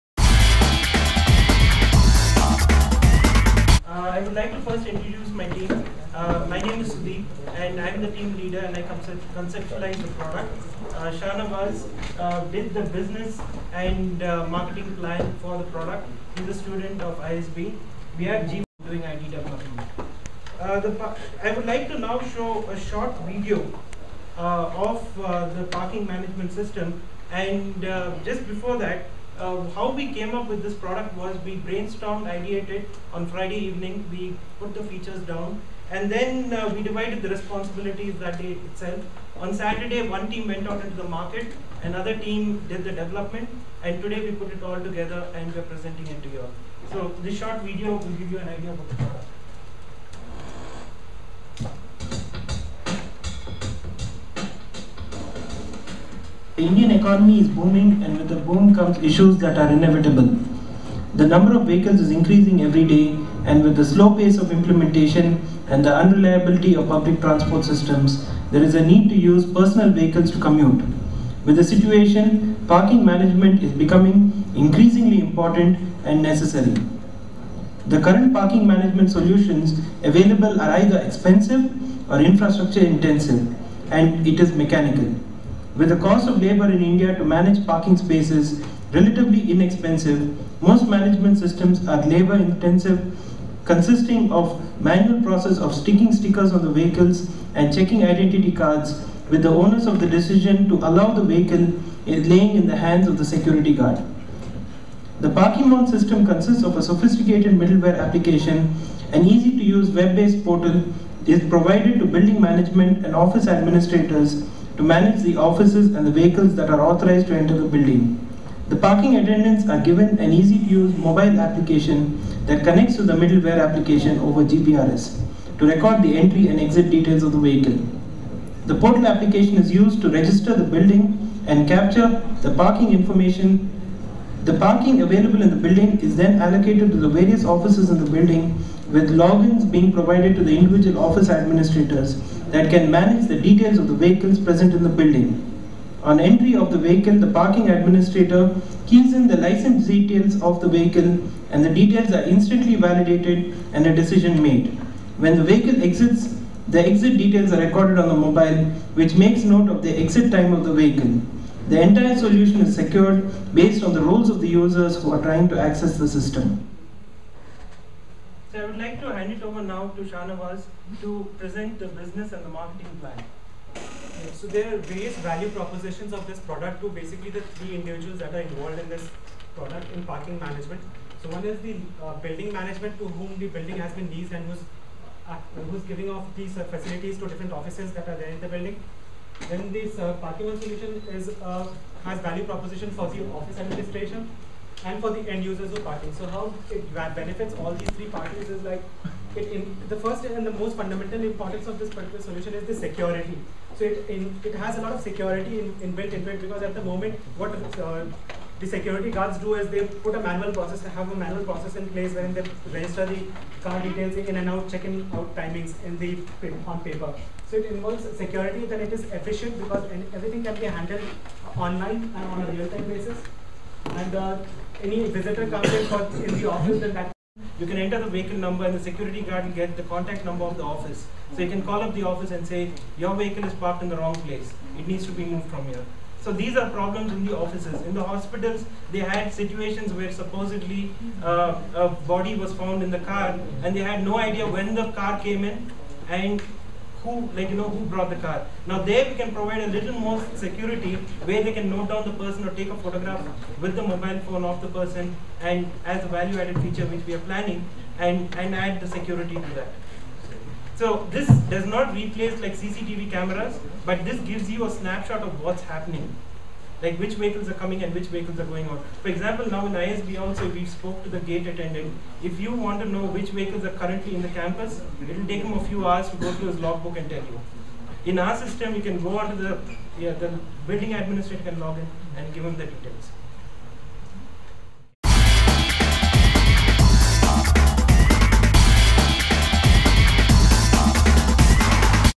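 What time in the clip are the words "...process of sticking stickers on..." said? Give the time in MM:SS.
01:35.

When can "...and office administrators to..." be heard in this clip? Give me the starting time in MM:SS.
01:53.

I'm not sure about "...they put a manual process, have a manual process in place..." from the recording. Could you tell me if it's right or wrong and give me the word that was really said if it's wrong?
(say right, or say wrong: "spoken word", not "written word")
right.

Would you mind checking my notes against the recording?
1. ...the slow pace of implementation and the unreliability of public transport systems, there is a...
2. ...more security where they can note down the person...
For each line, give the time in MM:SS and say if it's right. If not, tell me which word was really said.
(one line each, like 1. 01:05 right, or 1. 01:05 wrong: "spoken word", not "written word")
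1. 01:03 right
2. 04:09 right.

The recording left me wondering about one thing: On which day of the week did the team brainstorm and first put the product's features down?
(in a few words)
Friday.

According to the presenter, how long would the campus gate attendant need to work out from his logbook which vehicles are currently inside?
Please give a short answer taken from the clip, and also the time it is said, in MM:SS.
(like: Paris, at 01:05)
a few hours, at 04:35.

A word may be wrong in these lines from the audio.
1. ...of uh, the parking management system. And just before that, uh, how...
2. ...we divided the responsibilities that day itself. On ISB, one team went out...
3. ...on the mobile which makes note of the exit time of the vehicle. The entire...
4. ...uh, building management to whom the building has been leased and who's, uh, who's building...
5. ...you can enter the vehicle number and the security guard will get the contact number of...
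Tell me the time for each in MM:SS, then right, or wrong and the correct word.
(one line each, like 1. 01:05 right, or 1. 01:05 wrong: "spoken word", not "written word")
1. 00:24 right
2. 00:36 wrong: "Saturday", not "ISB"
3. 02:37 right
4. 03:02 wrong: "giving", not "building"
5. 03:47 right.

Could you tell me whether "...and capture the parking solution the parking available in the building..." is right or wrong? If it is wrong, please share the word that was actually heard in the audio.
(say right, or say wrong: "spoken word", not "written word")
wrong: "information", not "solution".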